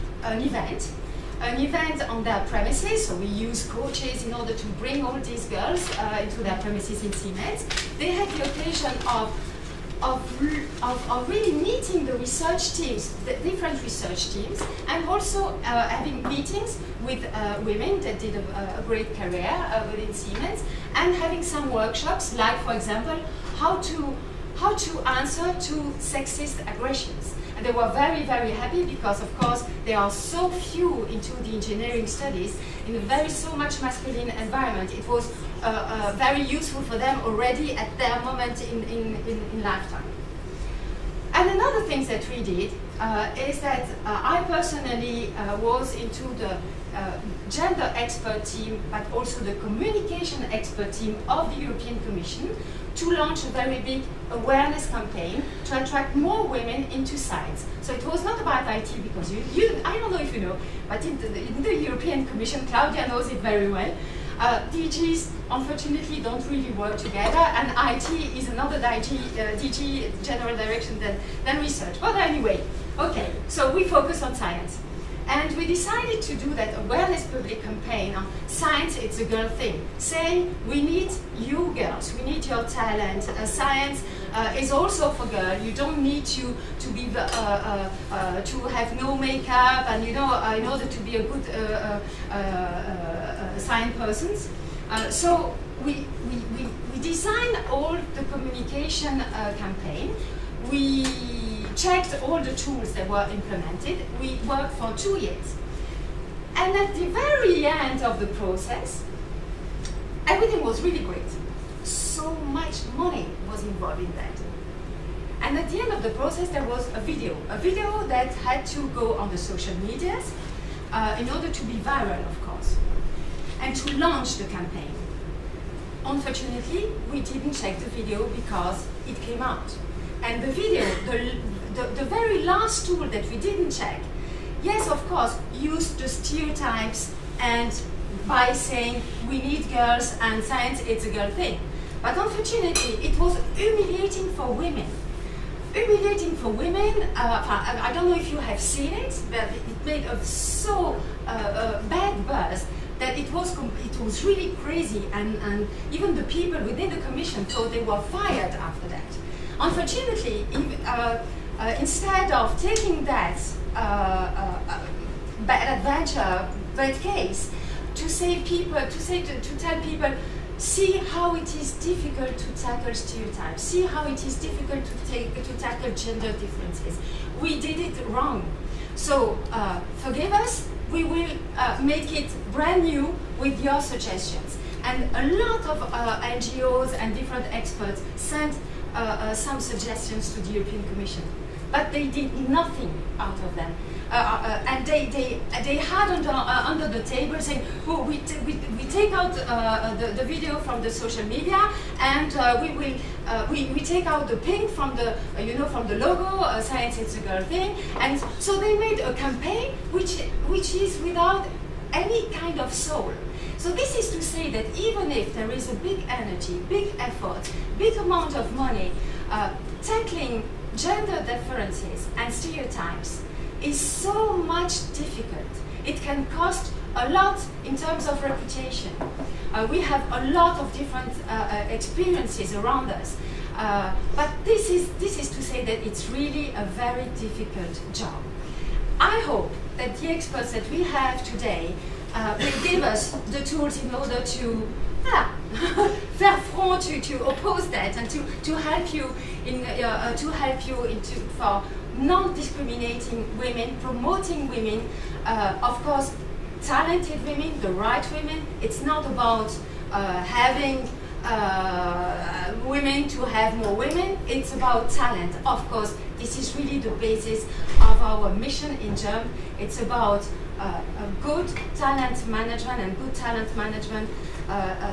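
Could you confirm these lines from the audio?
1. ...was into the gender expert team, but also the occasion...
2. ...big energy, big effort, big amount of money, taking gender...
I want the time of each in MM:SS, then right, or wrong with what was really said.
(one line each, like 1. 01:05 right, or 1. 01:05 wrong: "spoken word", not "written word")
1. 00:45 wrong: "communication", not "occasion"
2. 03:35 wrong: "tackling", not "taking".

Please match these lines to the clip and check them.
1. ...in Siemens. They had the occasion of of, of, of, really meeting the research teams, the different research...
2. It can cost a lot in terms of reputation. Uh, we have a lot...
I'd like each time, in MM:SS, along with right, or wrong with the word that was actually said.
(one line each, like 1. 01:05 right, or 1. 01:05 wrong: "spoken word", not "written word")
1. 00:07 right
2. 03:45 right.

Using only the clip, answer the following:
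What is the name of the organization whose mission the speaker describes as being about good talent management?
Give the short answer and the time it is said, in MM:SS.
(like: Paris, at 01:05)
JUMP, at 04:28.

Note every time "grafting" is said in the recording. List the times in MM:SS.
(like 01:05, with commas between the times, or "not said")
not said.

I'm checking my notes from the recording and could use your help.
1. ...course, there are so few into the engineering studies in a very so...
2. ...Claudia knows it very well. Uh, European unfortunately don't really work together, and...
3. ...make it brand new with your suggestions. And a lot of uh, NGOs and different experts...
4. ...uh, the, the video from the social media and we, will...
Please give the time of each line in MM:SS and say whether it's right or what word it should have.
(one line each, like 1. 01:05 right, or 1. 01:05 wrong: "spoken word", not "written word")
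1. 00:29 right
2. 01:02 wrong: "DGs", not "European"
3. 03:01 right
4. 03:19 right.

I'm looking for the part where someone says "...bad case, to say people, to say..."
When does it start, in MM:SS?
02:46.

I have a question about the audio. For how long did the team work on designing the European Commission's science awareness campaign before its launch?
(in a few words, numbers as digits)
two years.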